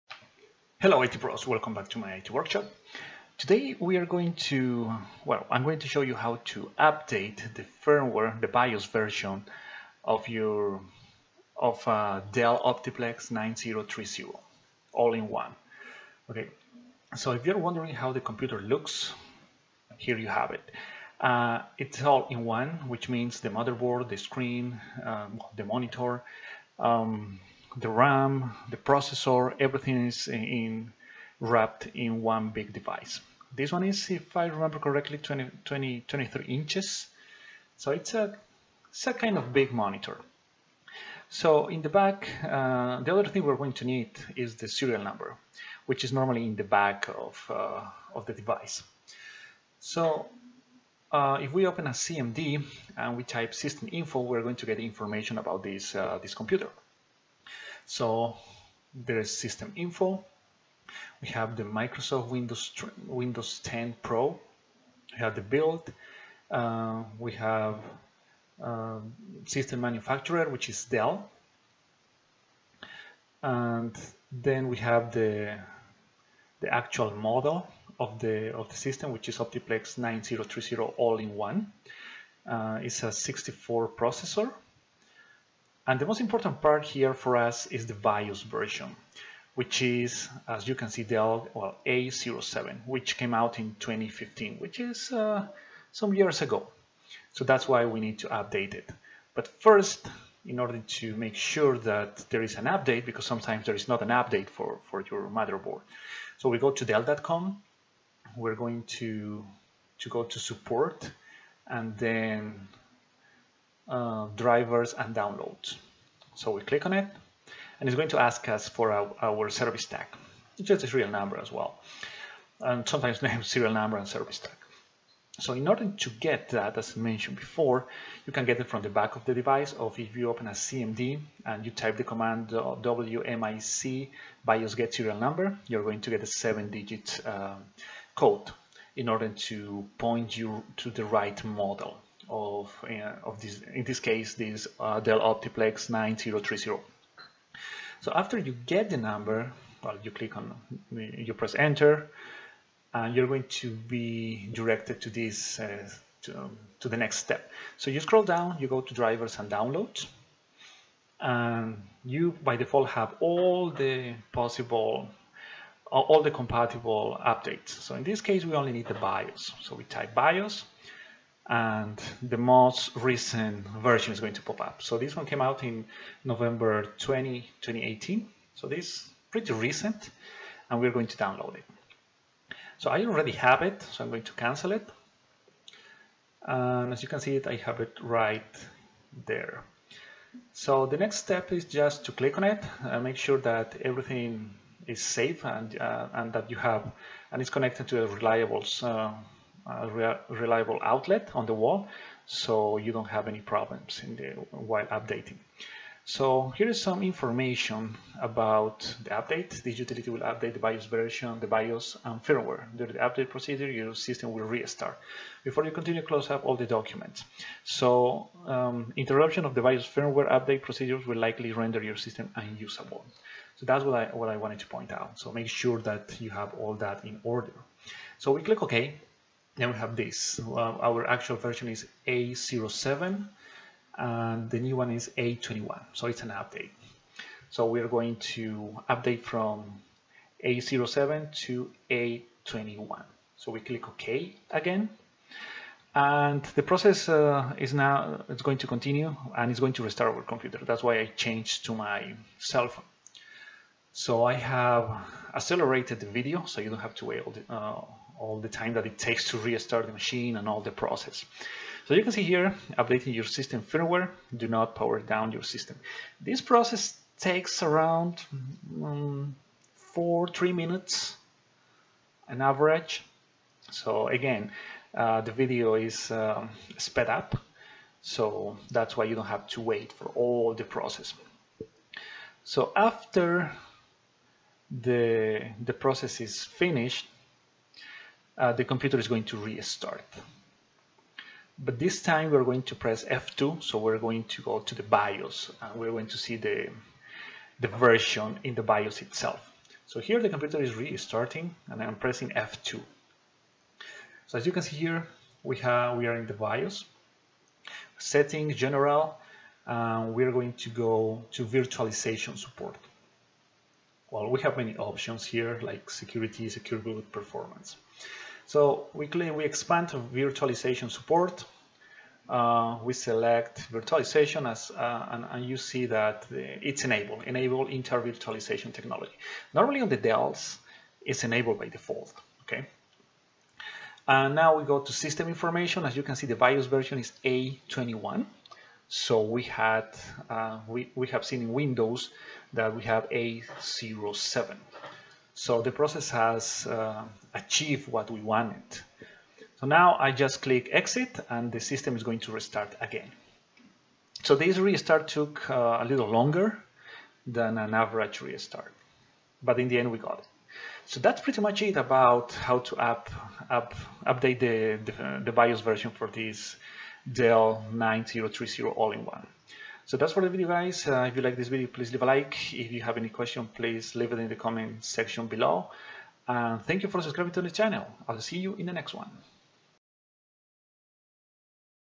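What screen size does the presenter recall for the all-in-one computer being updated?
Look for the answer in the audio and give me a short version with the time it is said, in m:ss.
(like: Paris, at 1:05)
23 inches, at 0:36.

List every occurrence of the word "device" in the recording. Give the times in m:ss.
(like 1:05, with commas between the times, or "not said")
0:32, 0:48, 2:09.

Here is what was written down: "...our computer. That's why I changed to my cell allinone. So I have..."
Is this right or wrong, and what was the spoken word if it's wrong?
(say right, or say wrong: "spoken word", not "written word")
wrong: "phone", not "allinone".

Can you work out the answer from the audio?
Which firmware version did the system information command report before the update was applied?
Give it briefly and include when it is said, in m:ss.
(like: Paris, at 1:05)
A07, at 1:31.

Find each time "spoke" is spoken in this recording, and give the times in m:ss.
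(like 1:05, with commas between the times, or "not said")
not said.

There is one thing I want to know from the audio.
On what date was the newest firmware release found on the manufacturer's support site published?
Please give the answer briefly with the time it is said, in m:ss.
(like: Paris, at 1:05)
November 20, 2018, at 2:56.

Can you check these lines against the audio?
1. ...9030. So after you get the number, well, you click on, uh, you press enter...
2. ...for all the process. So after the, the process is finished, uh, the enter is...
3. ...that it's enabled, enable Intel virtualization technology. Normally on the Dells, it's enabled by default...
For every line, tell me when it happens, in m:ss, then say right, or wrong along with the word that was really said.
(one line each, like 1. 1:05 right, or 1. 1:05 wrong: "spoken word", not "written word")
1. 2:25 right
2. 4:39 wrong: "computer", not "enter"
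3. 5:25 right.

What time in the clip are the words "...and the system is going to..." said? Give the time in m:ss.
5:51.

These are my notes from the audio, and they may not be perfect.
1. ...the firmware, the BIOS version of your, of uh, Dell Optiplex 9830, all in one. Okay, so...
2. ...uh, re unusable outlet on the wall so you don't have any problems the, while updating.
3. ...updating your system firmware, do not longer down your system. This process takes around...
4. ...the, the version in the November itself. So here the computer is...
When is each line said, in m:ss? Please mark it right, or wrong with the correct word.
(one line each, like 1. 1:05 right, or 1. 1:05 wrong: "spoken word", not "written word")
1. 0:07 wrong: "9030", not "9830"
2. 3:18 wrong: "reliable", not "unusable"
3. 4:22 wrong: "power", not "longer"
4. 4:56 wrong: "BIOS", not "November".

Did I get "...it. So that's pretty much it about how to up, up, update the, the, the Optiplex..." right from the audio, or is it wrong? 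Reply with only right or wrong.
wrong.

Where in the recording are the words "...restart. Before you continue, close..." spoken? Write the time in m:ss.
3:34.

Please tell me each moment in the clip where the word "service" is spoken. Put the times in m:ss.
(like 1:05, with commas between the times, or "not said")
1:59, 2:04.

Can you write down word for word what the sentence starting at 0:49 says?
So uh, if we open a CMD and we type system info, we're going to get information about this, uh, this computer.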